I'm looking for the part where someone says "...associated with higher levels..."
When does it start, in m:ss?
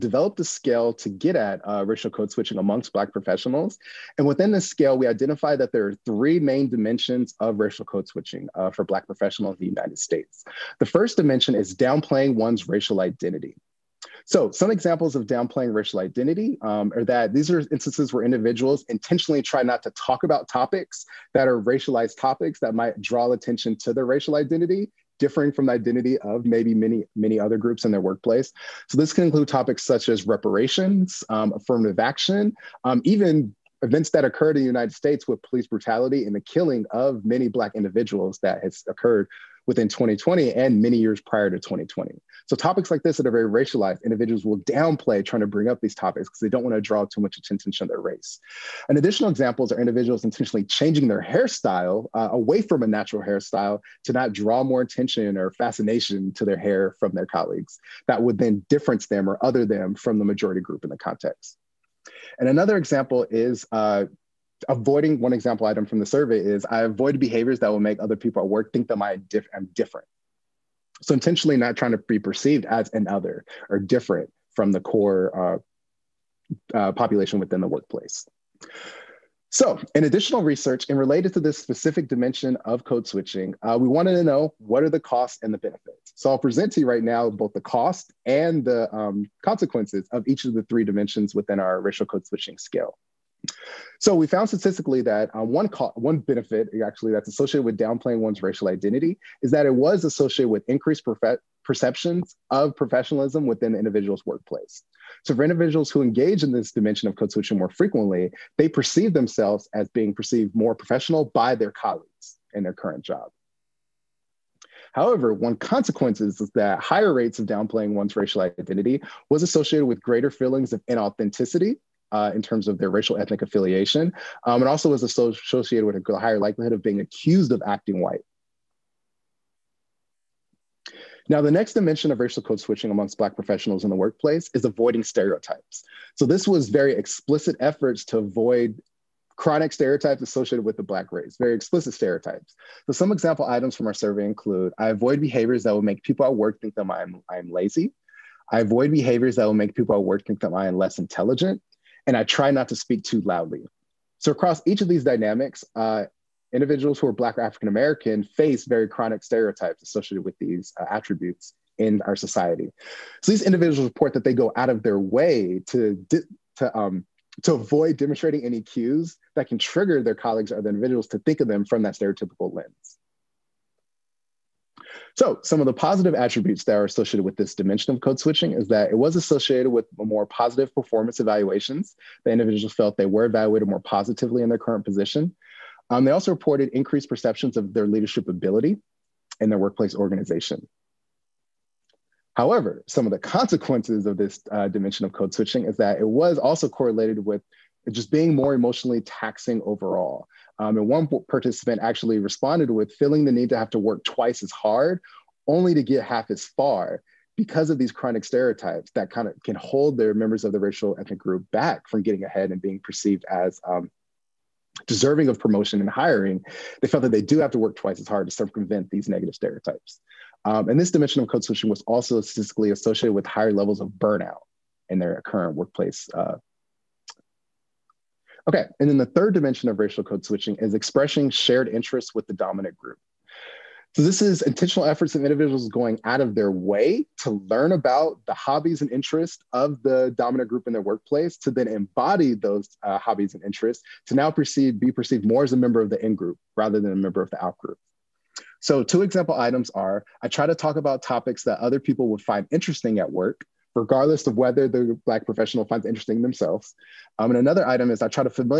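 3:42.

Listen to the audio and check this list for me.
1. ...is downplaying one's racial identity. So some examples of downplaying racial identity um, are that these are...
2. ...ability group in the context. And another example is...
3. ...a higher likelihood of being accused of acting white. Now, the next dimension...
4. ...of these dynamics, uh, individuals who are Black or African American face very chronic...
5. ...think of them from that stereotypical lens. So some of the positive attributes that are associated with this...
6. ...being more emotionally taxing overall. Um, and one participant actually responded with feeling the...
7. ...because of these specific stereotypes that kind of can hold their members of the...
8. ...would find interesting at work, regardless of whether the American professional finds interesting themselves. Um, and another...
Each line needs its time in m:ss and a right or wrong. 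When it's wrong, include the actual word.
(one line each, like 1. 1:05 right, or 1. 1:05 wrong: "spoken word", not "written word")
1. 0:11 right
2. 1:00 wrong: "majority", not "ability"
3. 2:05 right
4. 2:34 right
5. 2:51 right
6. 3:18 right
7. 3:27 wrong: "chronic", not "specific"
8. 4:12 wrong: "Black", not "American".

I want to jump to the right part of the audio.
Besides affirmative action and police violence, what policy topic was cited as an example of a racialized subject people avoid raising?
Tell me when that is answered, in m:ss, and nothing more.
0:30.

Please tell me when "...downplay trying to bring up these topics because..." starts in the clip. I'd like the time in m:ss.
0:44.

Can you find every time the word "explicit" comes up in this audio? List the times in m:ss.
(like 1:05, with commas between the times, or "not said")
2:16, 2:21.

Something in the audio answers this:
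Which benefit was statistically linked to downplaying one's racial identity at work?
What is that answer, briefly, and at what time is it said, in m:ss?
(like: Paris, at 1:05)
Perceptions of professionalism, at 1:41.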